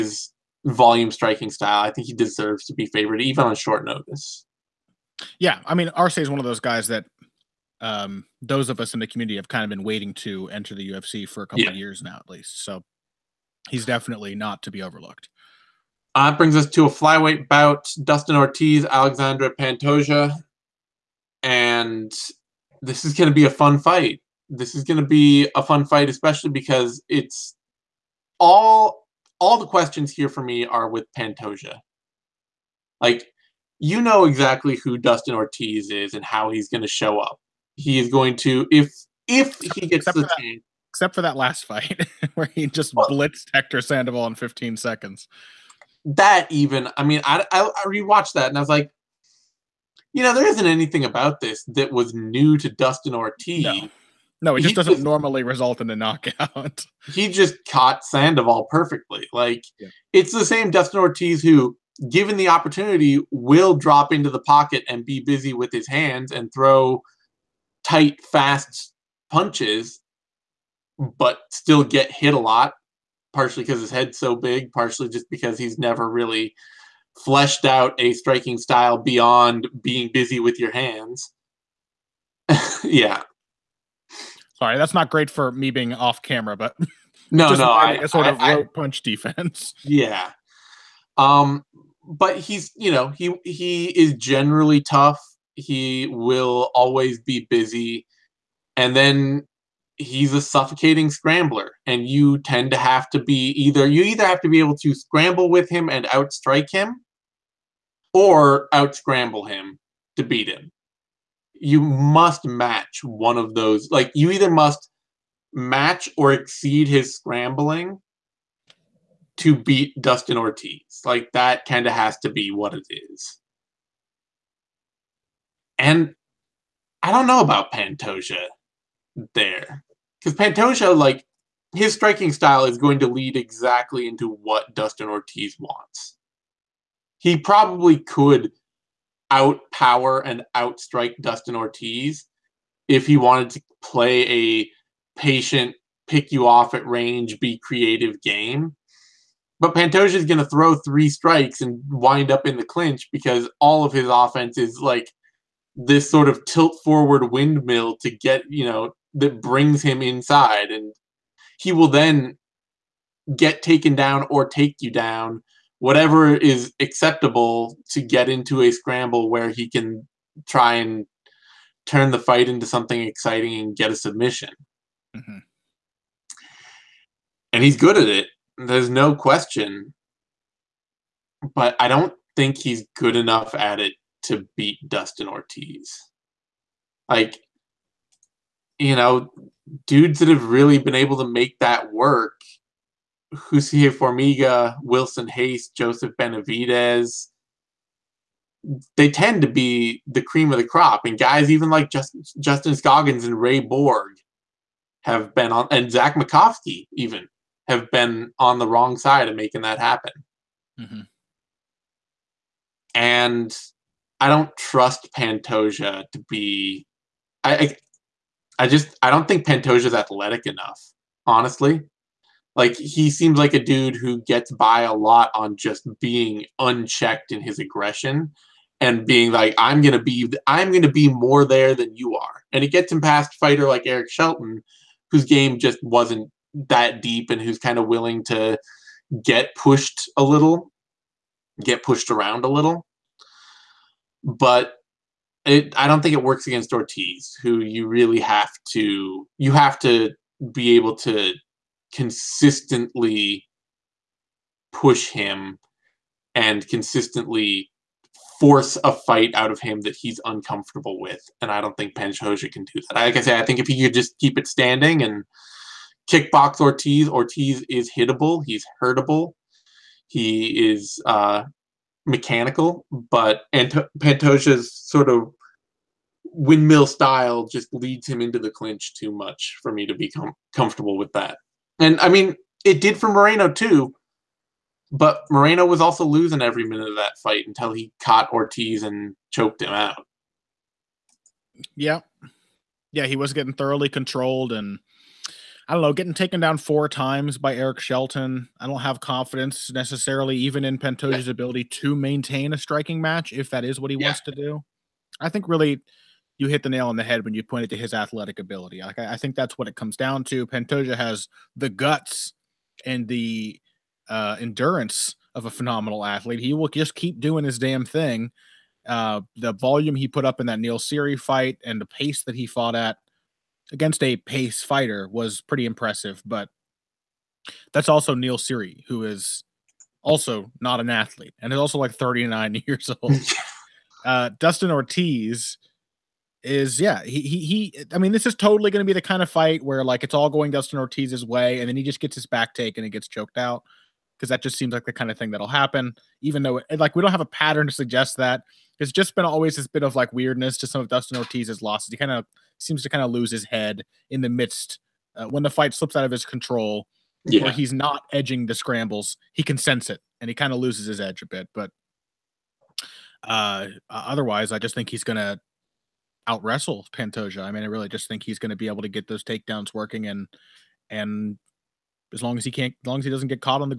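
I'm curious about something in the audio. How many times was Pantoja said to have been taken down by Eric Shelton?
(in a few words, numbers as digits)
4.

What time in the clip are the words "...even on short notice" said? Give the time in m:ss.
0:03.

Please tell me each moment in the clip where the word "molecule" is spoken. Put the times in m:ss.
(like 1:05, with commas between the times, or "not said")
not said.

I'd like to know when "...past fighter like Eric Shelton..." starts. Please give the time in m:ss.
3:52.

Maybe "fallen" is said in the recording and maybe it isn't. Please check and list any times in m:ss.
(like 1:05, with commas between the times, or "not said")
not said.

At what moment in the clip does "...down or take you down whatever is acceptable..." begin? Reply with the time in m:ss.
2:43.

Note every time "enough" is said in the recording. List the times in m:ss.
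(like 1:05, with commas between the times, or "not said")
3:03, 3:40.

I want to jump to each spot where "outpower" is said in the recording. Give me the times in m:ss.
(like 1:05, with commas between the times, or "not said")
2:19.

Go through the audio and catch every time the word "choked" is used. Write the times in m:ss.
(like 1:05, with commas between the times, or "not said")
4:49, 5:43.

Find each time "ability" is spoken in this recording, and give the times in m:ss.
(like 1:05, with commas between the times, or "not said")
5:01, 5:08.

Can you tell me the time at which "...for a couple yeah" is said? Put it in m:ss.
0:11.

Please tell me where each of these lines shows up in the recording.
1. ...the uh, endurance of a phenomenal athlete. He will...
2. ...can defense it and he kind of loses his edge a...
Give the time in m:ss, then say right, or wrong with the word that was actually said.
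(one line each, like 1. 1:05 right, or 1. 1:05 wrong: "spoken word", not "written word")
1. 5:13 right
2. 5:59 wrong: "sense", not "defense".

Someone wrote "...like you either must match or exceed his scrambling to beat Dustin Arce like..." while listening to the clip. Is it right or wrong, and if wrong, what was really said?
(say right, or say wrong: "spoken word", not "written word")
wrong: "Ortiz", not "Arce".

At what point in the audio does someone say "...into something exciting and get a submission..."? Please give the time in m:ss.
2:52.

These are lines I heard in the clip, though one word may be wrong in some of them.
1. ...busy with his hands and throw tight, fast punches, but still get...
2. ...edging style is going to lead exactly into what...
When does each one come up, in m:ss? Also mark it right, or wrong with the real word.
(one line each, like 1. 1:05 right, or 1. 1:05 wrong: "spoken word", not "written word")
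1. 1:05 right
2. 2:11 wrong: "striking", not "edging".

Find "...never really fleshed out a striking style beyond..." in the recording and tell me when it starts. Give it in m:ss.
1:15.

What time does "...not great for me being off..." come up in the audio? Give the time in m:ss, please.
1:24.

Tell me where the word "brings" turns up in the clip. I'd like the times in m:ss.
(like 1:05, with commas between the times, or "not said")
0:16, 2:39.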